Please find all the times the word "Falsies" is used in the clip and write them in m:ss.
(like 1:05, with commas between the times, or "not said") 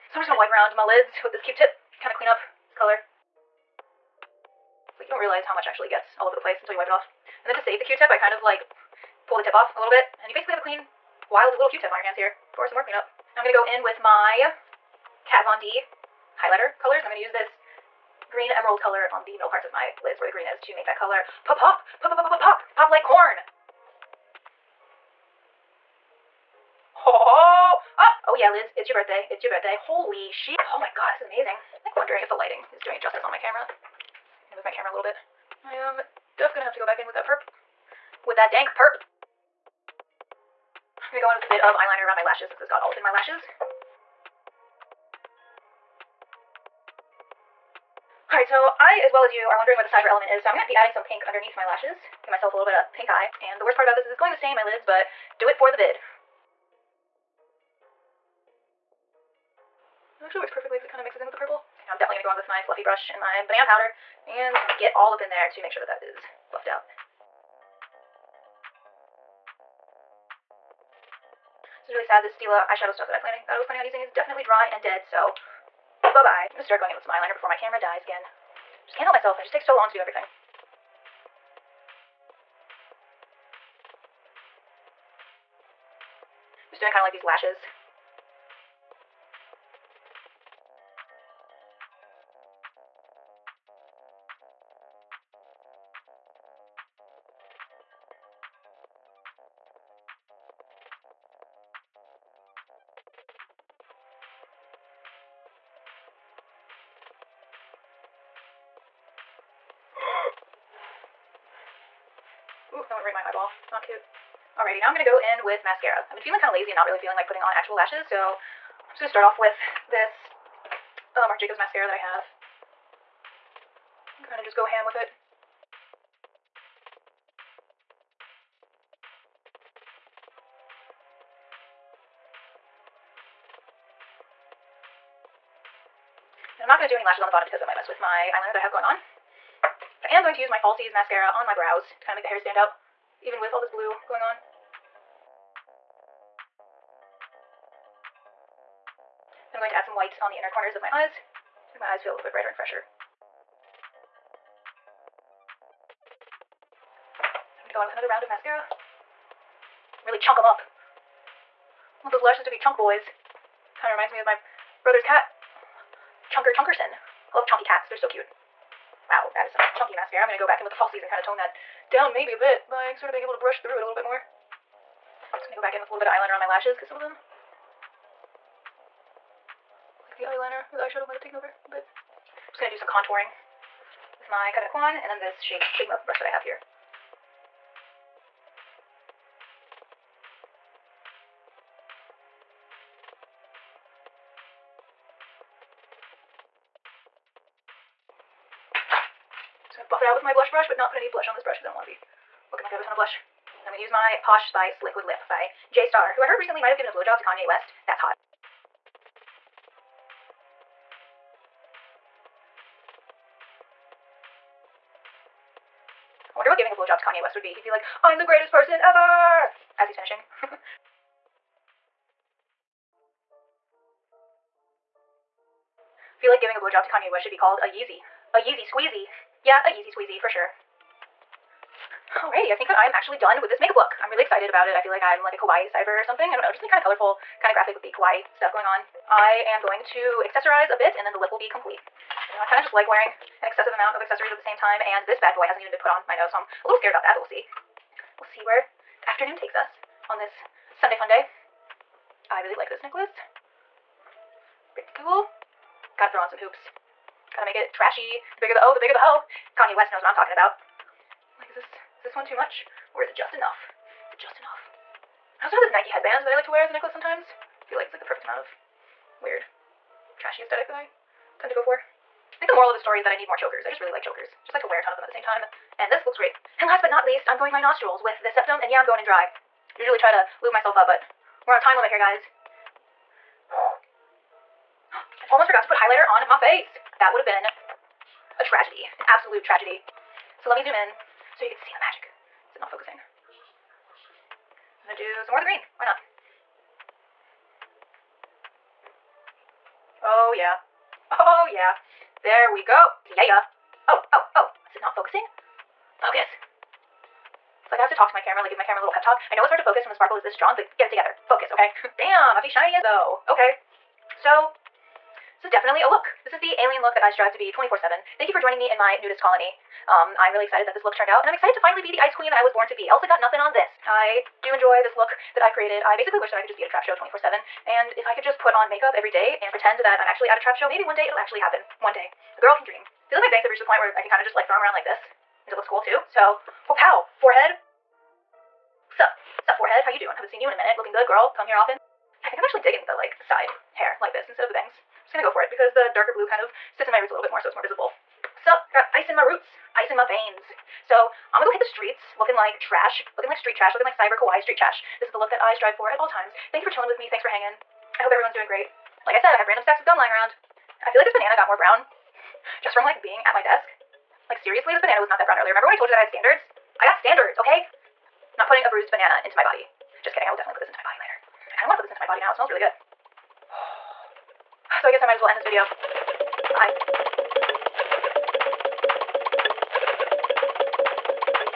2:20, 2:50.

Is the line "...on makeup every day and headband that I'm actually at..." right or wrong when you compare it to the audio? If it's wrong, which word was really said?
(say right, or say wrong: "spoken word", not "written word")
wrong: "pretend", not "headband".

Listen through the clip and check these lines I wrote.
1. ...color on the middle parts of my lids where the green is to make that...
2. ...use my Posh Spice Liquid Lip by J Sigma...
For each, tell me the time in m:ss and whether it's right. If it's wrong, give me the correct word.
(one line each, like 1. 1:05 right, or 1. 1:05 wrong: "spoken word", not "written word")
1. 0:18 right
2. 3:23 wrong: "Star", not "Sigma".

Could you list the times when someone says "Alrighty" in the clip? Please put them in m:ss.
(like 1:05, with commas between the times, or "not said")
1:54, 3:52.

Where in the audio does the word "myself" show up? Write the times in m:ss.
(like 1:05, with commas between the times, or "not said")
0:52, 1:19, 4:40.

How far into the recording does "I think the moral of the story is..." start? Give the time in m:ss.
4:32.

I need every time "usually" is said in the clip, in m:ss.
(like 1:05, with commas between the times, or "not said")
4:39.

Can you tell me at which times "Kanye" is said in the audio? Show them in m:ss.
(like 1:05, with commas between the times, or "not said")
3:27, 3:37, 3:46, 4:19.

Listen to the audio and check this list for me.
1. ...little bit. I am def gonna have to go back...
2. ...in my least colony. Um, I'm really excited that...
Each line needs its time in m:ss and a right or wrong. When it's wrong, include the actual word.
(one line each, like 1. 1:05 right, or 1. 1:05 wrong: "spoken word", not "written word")
1. 0:34 right
2. 5:18 wrong: "nudist", not "least".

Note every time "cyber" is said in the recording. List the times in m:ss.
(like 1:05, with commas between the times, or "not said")
0:49, 3:55, 5:53.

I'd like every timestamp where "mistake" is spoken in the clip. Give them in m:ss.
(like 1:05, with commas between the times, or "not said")
not said.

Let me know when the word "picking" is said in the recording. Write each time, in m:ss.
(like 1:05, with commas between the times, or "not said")
not said.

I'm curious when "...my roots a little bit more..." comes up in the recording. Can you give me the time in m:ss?
5:46.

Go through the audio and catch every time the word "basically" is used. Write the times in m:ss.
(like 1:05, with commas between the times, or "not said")
0:10, 5:25.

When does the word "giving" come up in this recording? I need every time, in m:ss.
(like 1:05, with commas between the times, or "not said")
3:36, 3:46.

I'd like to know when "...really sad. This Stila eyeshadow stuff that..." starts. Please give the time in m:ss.
1:11.